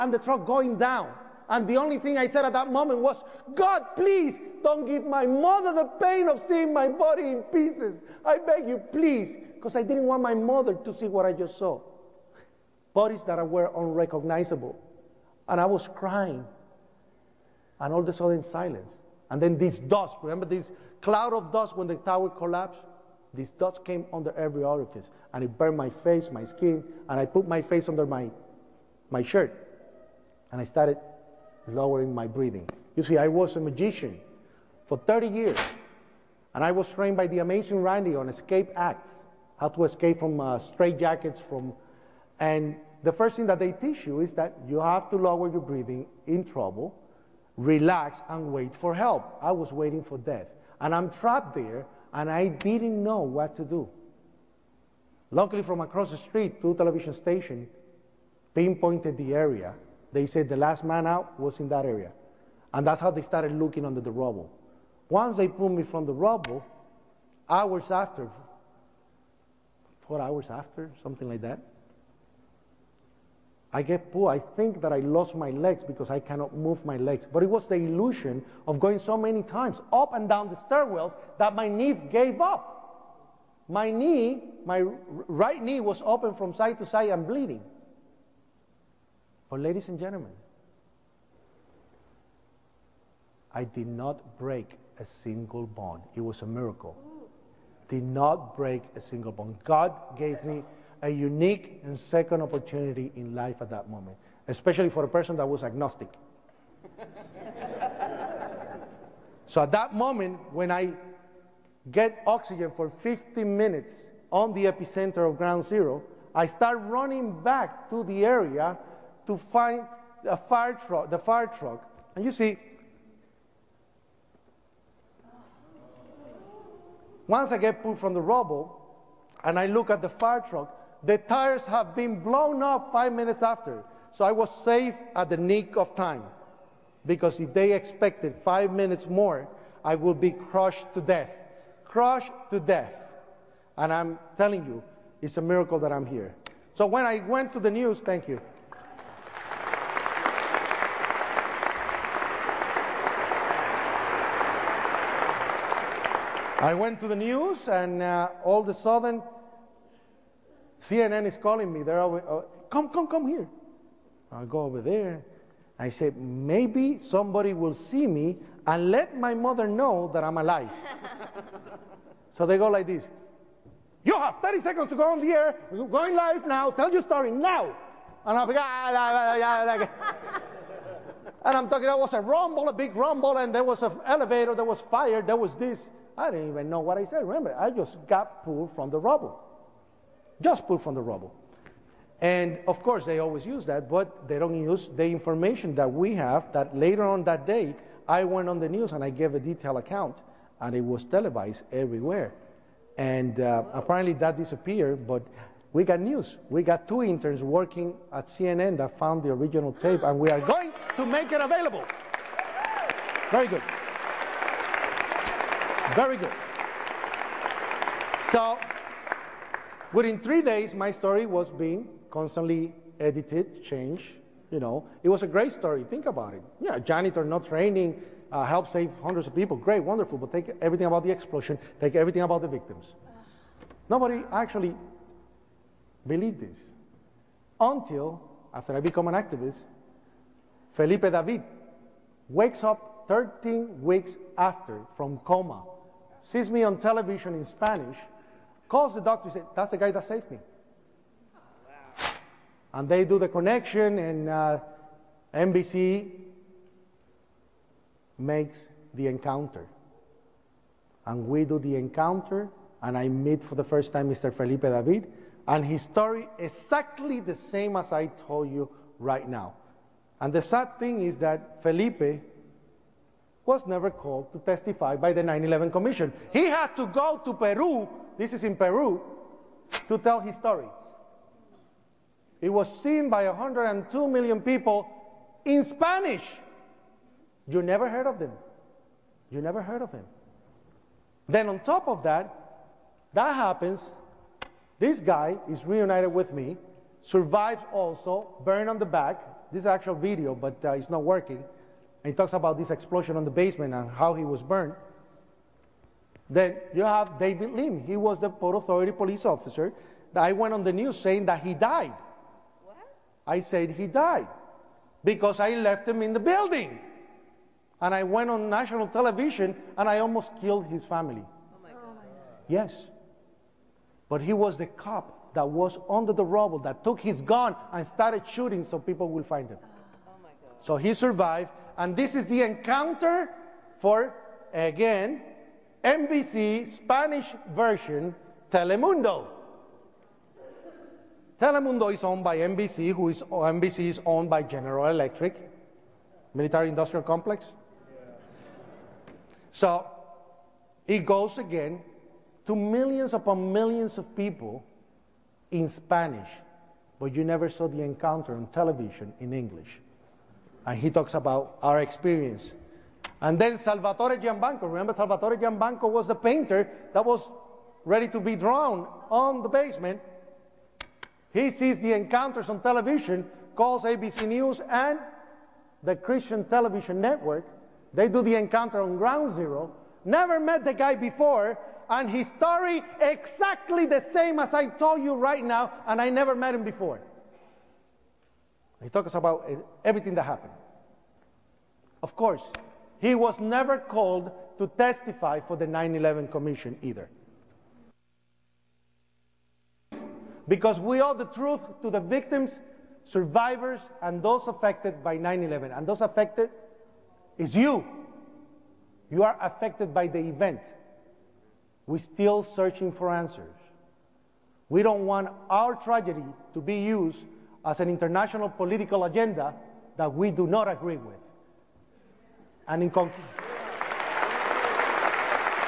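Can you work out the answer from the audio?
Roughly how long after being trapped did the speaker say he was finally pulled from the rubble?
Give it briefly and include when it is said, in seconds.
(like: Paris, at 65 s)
4 hours, at 70 s.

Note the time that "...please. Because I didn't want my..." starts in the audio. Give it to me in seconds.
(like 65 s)
8 s.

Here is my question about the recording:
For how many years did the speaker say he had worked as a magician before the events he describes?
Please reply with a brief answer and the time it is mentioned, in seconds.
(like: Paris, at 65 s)
30, at 34 s.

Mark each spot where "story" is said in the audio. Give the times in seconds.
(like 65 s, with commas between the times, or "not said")
177 s, 220 s, 225 s, 265 s, 280 s, 382 s.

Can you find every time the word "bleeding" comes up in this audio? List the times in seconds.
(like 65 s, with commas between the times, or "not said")
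87 s.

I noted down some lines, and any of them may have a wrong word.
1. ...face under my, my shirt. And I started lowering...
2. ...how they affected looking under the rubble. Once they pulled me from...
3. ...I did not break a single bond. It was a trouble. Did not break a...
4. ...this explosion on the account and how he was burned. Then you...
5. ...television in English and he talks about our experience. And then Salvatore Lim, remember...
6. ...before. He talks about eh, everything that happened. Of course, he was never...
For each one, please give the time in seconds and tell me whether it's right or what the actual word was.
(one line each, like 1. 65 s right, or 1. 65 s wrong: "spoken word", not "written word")
1. 27 s right
2. 63 s wrong: "started", not "affected"
3. 93 s wrong: "miracle", not "trouble"
4. 302 s wrong: "basement", not "account"
5. 358 s wrong: "Giambanna", not "Lim"
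6. 386 s right.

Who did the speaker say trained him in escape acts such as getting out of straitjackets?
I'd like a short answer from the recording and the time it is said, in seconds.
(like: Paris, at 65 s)
the amazing Randi, at 37 s.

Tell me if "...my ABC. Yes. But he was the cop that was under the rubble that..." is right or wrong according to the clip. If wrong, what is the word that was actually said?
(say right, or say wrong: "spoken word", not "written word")
wrong: "God", not "ABC".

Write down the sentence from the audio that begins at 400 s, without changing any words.
Because we owe the truth to the victims, survivors, and those affected by 9 11.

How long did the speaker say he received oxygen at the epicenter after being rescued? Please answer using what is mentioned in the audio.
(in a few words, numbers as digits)
50 minutes.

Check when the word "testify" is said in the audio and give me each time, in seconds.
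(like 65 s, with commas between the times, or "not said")
274 s, 394 s.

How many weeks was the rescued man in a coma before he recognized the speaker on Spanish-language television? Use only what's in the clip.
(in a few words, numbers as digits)
13.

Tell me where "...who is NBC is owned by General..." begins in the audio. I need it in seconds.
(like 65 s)
342 s.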